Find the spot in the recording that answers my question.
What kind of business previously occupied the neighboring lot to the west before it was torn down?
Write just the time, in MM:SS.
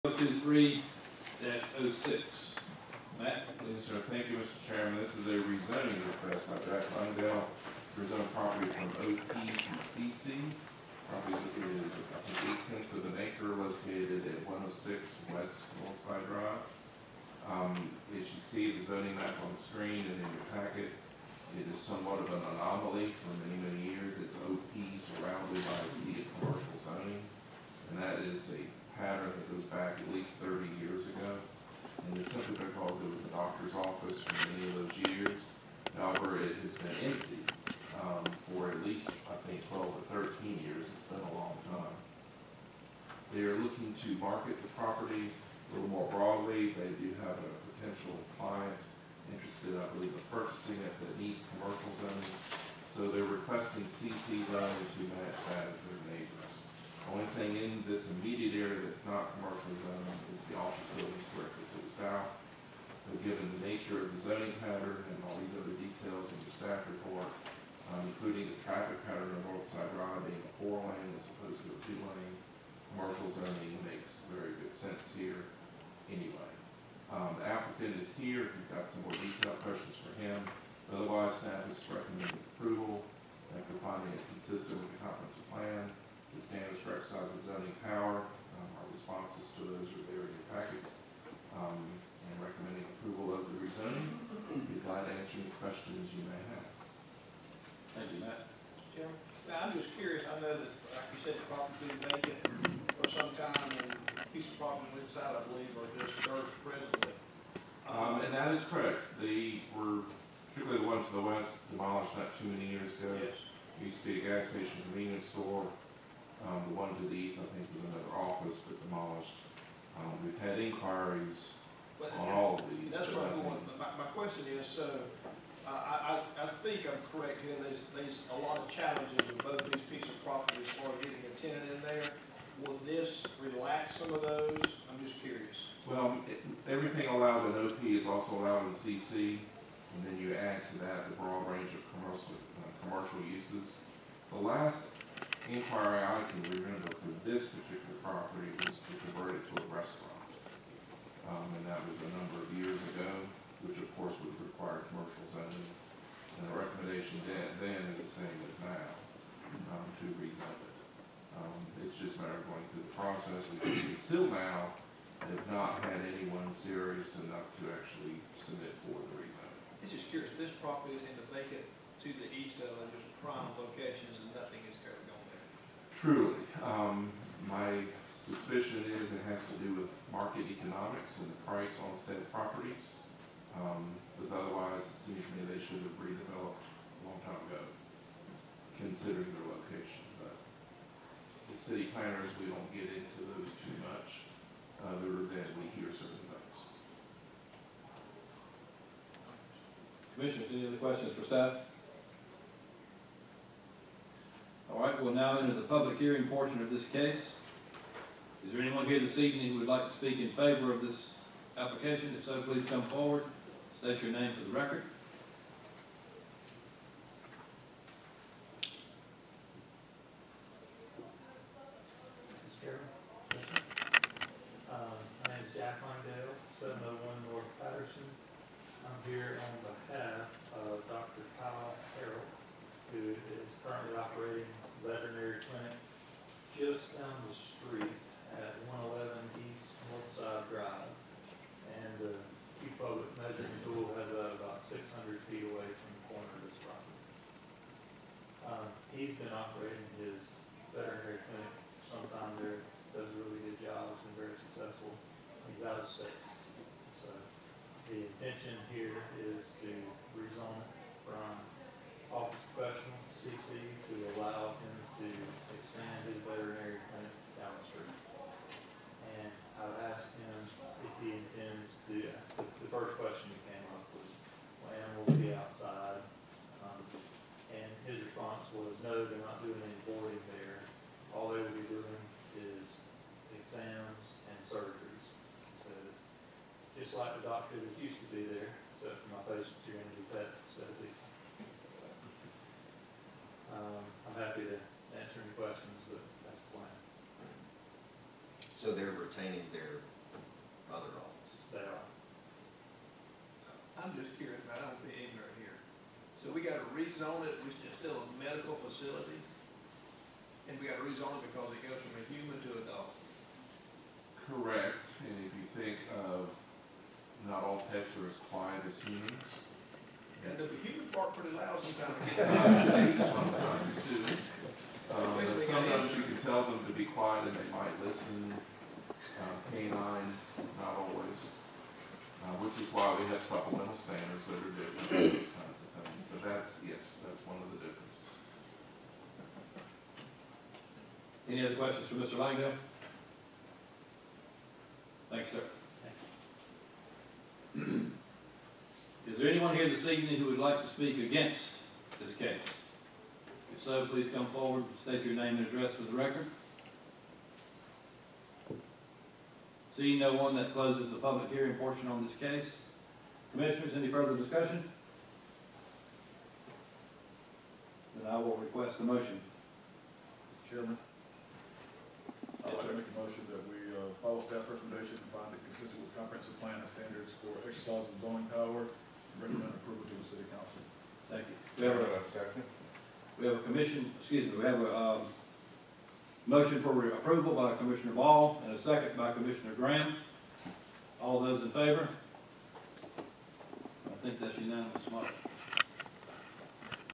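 01:54.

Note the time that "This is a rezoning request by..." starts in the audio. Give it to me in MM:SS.
00:05.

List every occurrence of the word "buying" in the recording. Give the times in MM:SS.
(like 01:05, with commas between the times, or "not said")
not said.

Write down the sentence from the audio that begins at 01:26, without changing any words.
The standards for exercise of zoning power.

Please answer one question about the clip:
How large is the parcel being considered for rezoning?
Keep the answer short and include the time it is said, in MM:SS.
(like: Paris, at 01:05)
0.8 acre, at 00:12.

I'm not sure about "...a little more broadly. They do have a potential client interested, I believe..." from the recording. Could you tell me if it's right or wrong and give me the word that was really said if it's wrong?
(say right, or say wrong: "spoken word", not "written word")
right.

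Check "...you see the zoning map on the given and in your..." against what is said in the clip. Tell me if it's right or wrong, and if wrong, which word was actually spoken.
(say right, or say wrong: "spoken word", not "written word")
wrong: "screen", not "given".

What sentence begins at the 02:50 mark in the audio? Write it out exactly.
This property in the vacant to the east of it is prime locations and nothing is currently going there.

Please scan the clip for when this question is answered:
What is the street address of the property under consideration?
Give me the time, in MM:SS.
00:14.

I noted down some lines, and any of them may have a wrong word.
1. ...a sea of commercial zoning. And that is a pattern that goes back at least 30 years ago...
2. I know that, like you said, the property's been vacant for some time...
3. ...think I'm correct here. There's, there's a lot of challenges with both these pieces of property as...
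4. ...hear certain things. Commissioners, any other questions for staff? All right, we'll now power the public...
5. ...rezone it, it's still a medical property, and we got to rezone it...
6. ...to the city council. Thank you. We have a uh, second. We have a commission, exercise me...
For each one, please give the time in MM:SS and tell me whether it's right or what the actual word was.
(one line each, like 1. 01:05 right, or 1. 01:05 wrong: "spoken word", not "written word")
1. 00:25 right
2. 01:40 right
3. 02:06 right
4. 03:15 wrong: "enter", not "power"
5. 05:06 wrong: "facility", not "property"
6. 06:19 wrong: "excuse", not "exercise".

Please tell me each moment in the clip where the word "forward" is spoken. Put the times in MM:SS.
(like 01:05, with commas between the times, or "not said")
03:32, 05:54.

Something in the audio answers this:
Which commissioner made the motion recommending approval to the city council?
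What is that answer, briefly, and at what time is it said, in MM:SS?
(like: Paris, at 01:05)
Ball, at 06:27.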